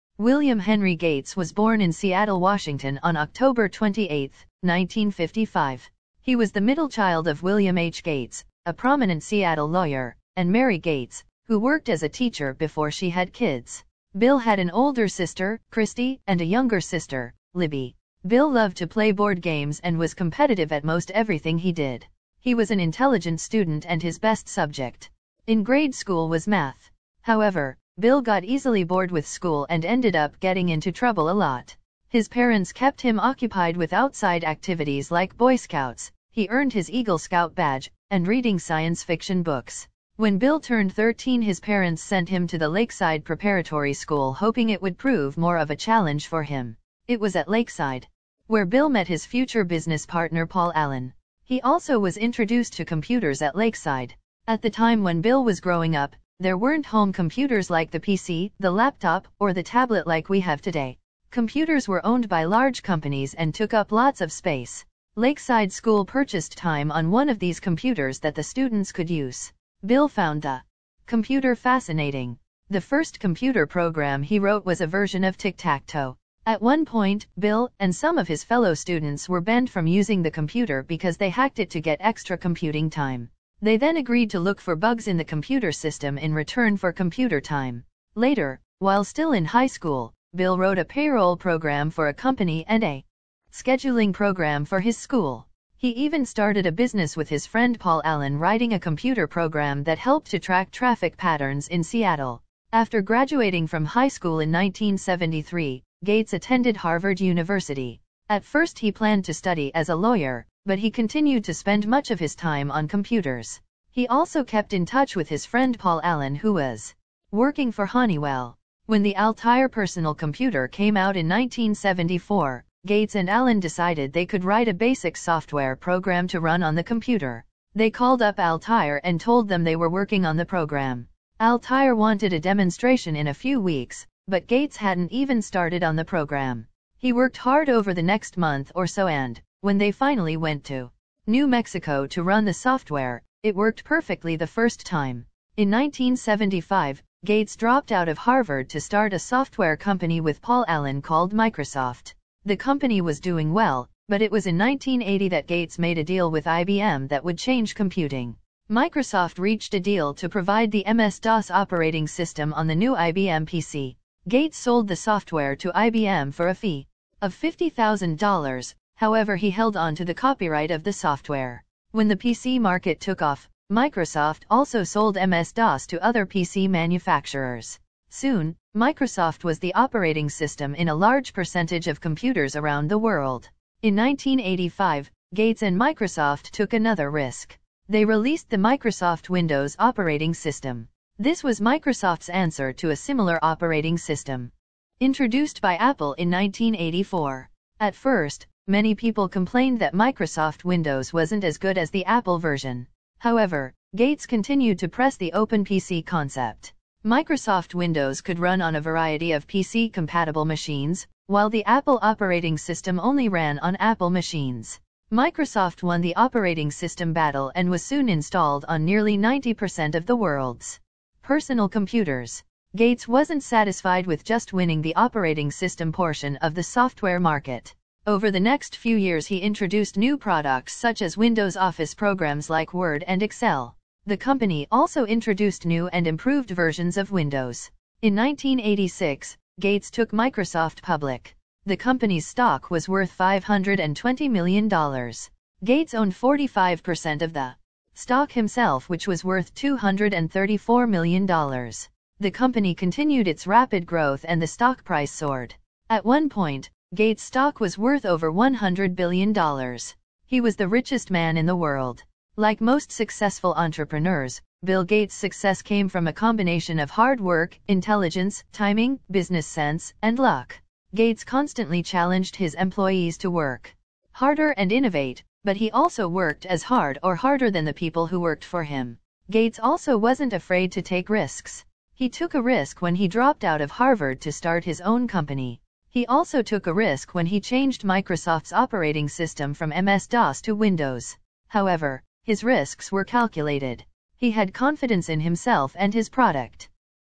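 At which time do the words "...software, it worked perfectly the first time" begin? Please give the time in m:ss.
2:22.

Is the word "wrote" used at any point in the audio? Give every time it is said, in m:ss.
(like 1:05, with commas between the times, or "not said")
1:14, 1:30.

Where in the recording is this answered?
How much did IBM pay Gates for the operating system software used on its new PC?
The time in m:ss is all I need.
2:47.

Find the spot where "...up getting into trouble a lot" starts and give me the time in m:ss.
0:30.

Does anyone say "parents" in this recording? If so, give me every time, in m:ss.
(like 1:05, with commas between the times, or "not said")
0:32, 0:41.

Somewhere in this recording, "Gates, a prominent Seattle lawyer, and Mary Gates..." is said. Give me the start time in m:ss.
0:08.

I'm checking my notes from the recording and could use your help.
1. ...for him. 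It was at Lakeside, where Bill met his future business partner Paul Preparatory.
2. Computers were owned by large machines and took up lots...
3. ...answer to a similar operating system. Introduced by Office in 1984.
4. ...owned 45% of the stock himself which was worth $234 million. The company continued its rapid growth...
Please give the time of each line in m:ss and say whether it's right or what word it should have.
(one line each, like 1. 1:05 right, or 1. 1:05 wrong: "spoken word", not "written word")
1. 0:46 wrong: "Allen", not "Preparatory"
2. 1:01 wrong: "companies", not "machines"
3. 3:12 wrong: "Apple", not "Office"
4. 4:05 right.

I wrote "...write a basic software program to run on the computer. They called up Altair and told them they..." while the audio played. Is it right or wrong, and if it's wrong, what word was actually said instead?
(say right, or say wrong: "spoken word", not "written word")
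right.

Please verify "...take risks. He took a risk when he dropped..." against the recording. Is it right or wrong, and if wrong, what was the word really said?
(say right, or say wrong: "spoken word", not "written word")
right.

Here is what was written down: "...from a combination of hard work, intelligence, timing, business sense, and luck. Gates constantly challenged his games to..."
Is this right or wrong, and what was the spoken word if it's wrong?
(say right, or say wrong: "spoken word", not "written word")
wrong: "employees", not "games".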